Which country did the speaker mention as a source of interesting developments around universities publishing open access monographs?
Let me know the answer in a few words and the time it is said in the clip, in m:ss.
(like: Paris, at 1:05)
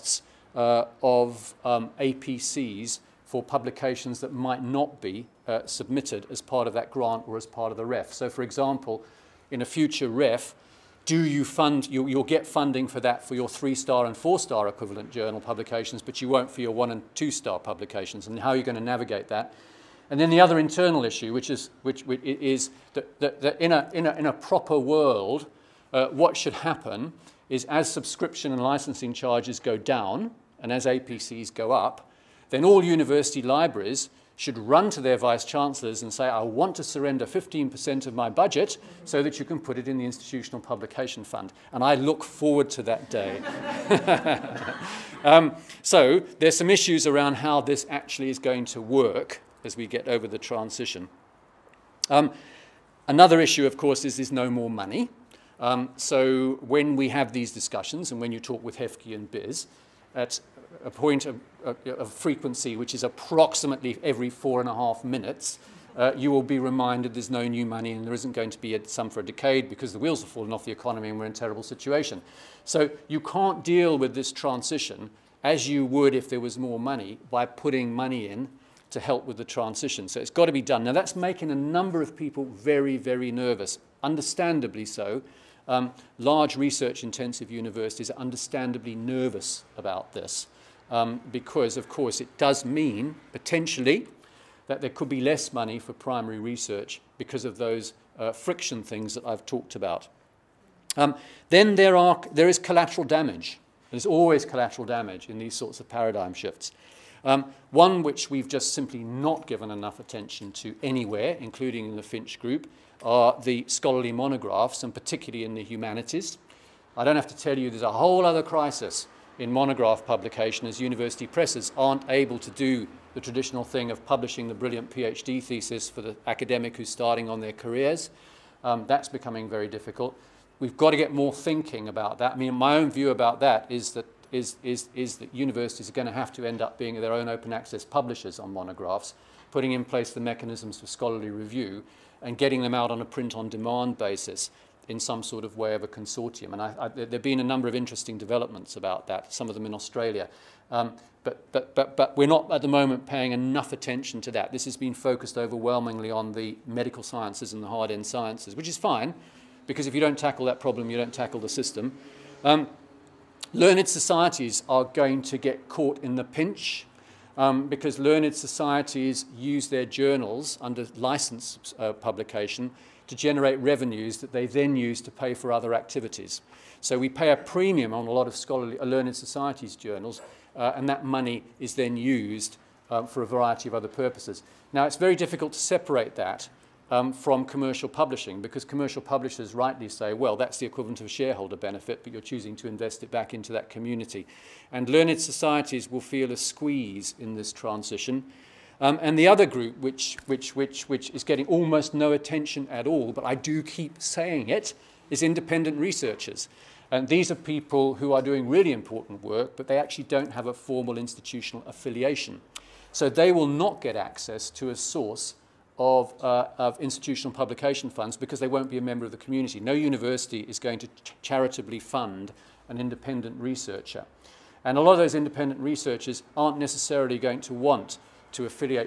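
Australia, at 2:29.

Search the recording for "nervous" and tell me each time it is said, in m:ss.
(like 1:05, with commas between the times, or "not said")
1:23, 1:28.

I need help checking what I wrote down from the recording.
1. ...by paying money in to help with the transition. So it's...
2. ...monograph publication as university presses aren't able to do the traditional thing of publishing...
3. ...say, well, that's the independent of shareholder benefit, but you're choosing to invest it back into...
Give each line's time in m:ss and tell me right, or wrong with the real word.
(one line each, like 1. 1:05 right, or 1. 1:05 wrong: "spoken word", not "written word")
1. 1:17 wrong: "putting", not "paying"
2. 1:59 right
3. 3:09 wrong: "equivalent", not "independent".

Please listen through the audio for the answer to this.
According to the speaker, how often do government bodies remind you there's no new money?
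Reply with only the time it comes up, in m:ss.
1:04.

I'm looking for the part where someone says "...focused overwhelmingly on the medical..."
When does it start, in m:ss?
2:34.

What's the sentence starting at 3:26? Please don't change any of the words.
And these are people who are doing really important work, but they actually don't have a formal institutional affiliation.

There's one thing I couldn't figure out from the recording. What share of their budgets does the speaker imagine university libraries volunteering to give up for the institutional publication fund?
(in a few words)
15%.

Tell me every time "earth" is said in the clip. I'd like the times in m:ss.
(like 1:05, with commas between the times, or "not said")
not said.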